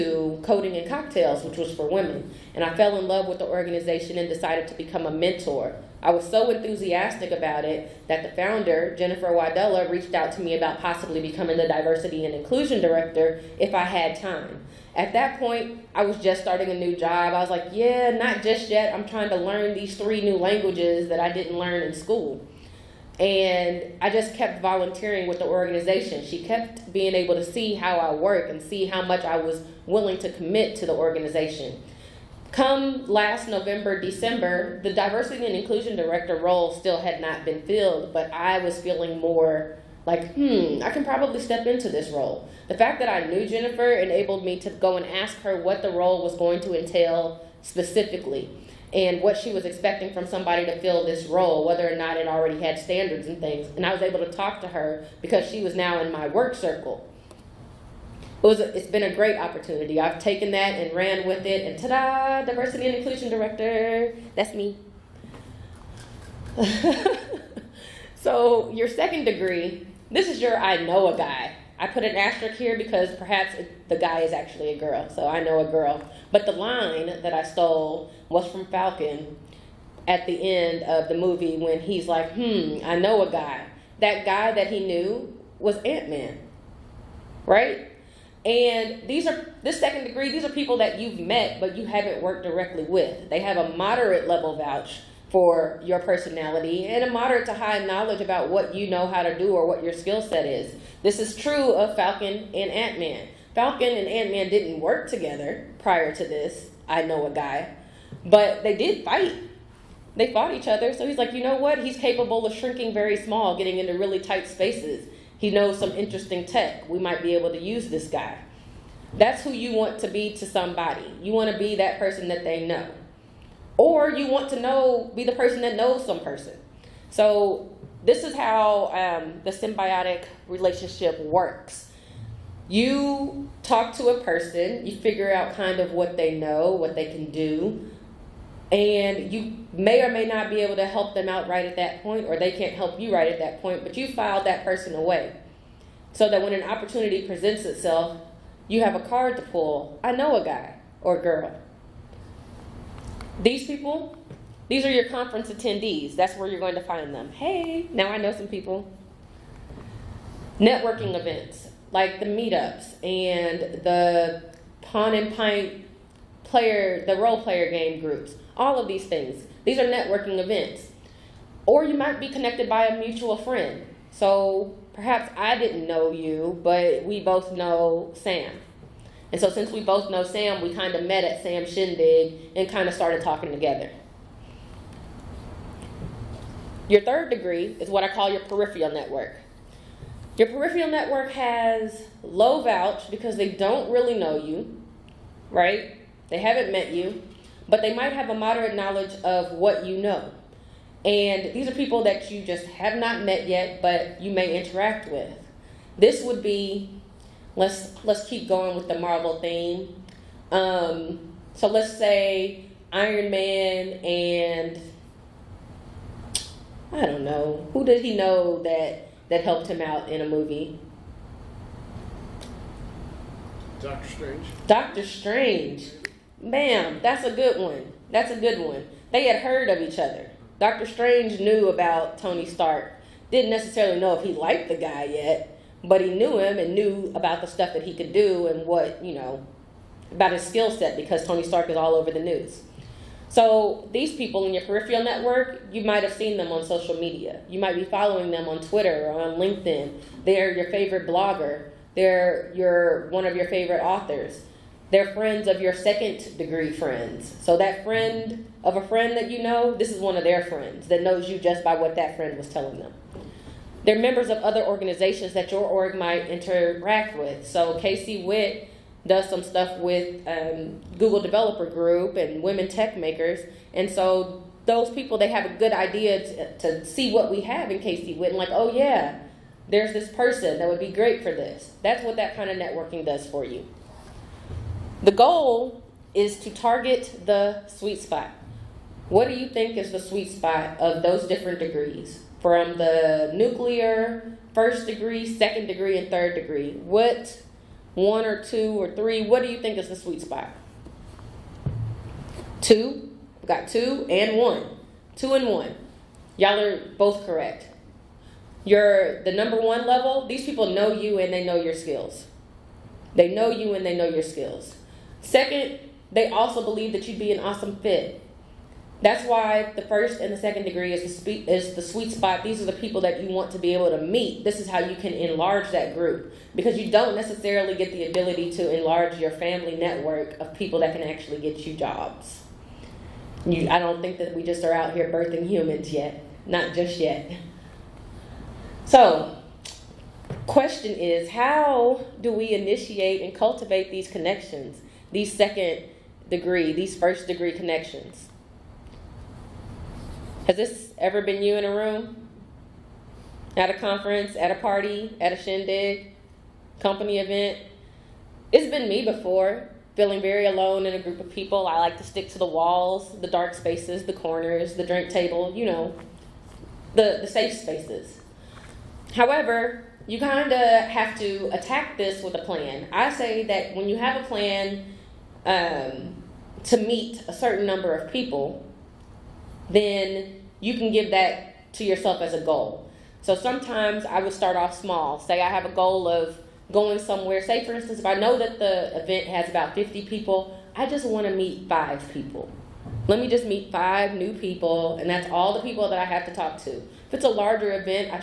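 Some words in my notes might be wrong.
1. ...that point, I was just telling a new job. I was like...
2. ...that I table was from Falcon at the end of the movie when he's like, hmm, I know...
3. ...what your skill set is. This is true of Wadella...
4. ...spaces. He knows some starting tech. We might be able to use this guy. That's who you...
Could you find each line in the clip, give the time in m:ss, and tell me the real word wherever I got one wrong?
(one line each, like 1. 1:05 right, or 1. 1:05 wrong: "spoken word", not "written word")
1. 0:15 wrong: "starting", not "telling"
2. 1:17 wrong: "stole", not "table"
3. 1:39 wrong: "Falcon", not "Wadella"
4. 1:54 wrong: "interesting", not "starting".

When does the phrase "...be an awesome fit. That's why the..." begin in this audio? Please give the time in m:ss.
5:17.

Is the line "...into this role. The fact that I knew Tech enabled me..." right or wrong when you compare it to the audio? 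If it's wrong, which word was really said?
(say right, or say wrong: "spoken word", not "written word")
wrong: "Jennifer", not "Tech".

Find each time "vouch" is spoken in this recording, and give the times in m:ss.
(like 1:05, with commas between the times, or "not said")
1:34, 3:12.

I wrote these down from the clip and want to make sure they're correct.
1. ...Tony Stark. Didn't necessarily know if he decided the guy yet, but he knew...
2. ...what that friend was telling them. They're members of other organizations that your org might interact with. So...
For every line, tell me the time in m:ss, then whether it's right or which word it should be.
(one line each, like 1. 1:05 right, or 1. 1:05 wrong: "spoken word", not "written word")
1. 3:52 wrong: "liked", not "decided"
2. 4:21 right.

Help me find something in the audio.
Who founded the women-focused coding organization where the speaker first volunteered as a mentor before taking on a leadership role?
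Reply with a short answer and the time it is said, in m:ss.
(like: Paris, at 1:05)
Jennifer Wadella, at 0:08.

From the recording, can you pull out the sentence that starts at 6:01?
I like to stick to the walls, the dark spaces, the corners, the drink table, you know, the, the safe spaces.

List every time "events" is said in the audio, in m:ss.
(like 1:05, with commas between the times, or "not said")
2:41, 2:50, 5:57, 6:29.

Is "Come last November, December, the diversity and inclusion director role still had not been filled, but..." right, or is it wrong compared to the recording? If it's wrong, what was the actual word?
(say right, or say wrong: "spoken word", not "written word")
right.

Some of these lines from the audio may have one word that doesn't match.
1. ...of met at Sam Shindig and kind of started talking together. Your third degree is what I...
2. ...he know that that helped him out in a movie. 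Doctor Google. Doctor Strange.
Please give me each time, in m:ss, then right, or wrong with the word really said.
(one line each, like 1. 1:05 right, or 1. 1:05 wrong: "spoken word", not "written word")
1. 3:00 right
2. 3:38 wrong: "Strange", not "Google".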